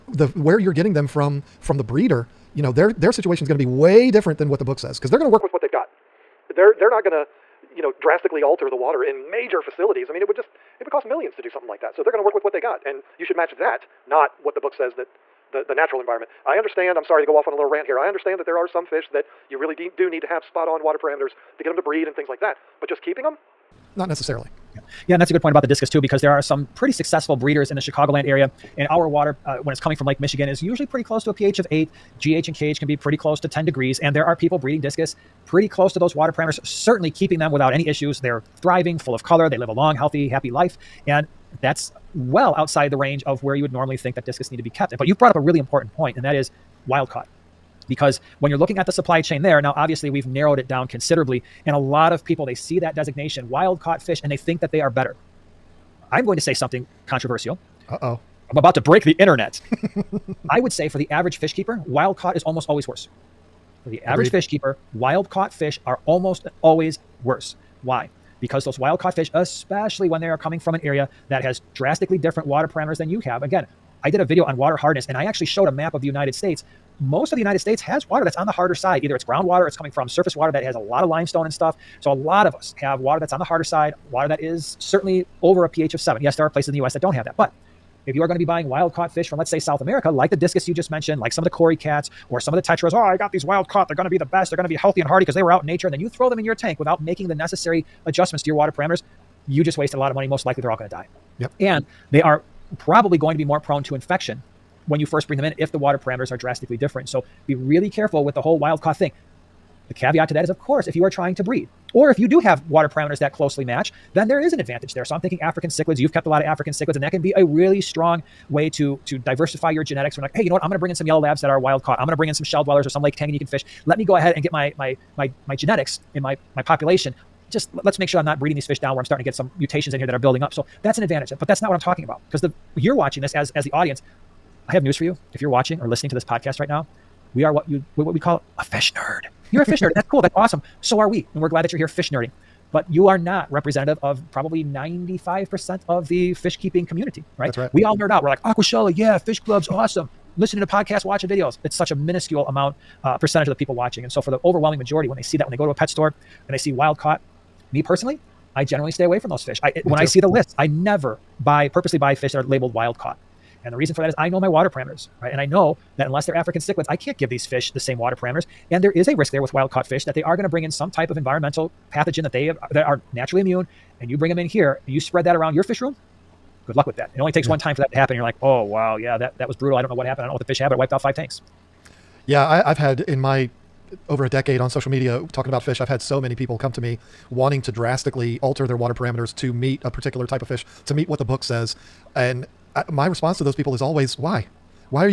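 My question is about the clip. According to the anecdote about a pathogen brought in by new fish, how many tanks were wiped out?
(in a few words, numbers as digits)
5.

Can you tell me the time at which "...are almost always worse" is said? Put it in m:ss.
1:05.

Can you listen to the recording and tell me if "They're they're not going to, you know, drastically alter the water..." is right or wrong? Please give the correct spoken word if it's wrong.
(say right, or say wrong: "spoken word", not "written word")
right.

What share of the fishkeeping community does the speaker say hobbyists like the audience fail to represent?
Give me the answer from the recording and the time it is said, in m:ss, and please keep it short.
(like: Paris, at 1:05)
95%, at 2:24.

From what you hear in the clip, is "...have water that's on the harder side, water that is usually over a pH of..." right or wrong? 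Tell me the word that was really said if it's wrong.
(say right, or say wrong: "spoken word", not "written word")
wrong: "certainly", not "usually".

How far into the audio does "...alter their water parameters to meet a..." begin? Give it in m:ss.
3:08.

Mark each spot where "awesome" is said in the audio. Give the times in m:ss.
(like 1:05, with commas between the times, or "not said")
2:20, 2:29.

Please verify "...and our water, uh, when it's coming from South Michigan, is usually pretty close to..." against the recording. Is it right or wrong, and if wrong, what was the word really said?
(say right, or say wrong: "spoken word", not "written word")
wrong: "Lake", not "South".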